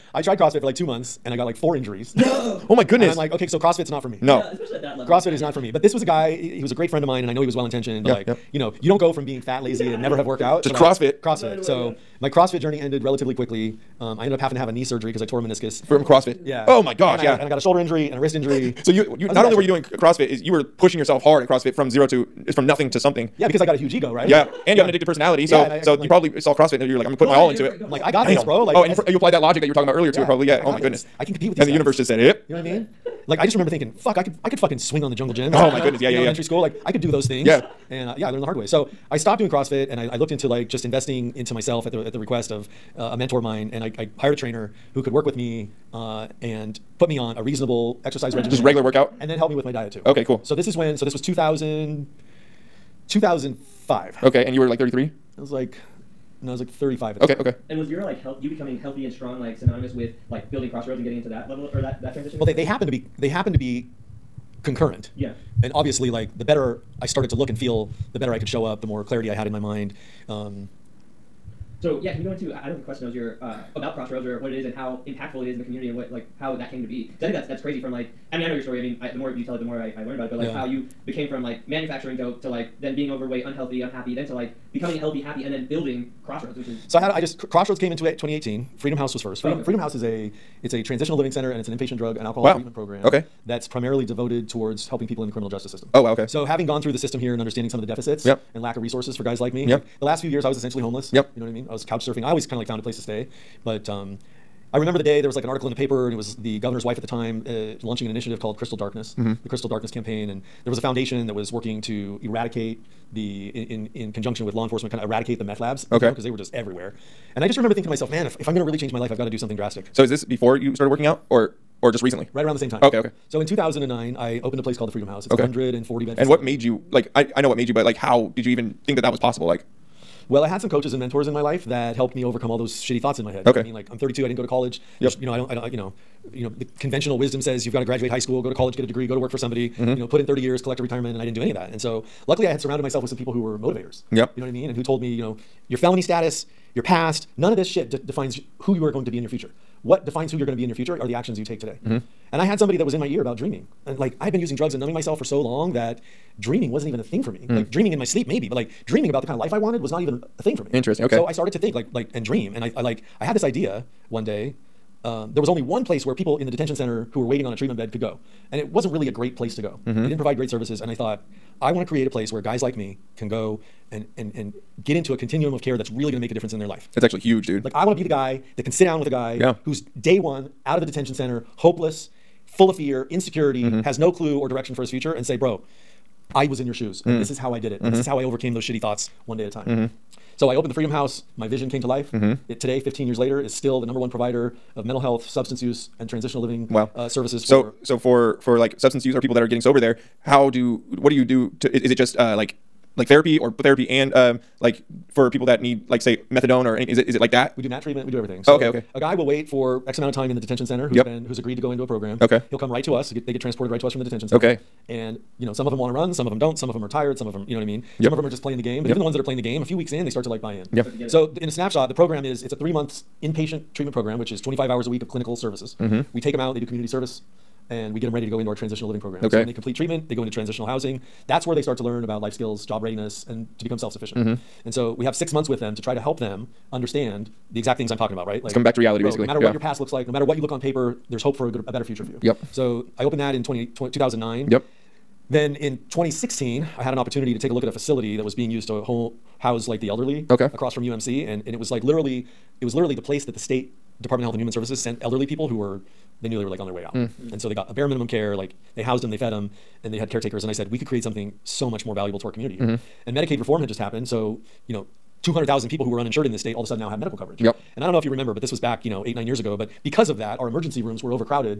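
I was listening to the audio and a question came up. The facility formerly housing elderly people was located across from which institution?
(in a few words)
UMC.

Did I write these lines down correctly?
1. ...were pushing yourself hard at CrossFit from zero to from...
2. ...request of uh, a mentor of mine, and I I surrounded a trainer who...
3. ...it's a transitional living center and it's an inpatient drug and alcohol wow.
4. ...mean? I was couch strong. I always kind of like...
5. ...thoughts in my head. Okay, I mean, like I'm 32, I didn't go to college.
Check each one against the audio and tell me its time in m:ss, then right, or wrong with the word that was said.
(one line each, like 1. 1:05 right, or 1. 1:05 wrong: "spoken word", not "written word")
1. 0:20 right
2. 0:42 wrong: "hired", not "surrounded"
3. 1:30 right
4. 1:41 wrong: "surfing", not "strong"
5. 2:13 right.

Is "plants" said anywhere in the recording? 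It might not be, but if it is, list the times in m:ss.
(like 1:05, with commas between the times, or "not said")
not said.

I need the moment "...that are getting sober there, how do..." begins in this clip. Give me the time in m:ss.
3:19.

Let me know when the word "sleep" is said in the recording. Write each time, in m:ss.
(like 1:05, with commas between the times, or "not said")
2:38.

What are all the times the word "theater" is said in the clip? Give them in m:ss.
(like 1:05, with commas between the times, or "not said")
not said.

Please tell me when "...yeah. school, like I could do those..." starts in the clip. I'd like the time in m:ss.
0:36.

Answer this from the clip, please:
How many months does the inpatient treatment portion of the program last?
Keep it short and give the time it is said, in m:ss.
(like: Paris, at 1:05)
3 months, at 3:42.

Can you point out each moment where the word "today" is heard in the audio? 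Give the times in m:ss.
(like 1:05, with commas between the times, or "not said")
2:31, 3:12.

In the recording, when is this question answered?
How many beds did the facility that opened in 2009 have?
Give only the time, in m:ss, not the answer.
2:05.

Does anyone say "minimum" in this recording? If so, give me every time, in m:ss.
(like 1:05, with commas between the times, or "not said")
4:17.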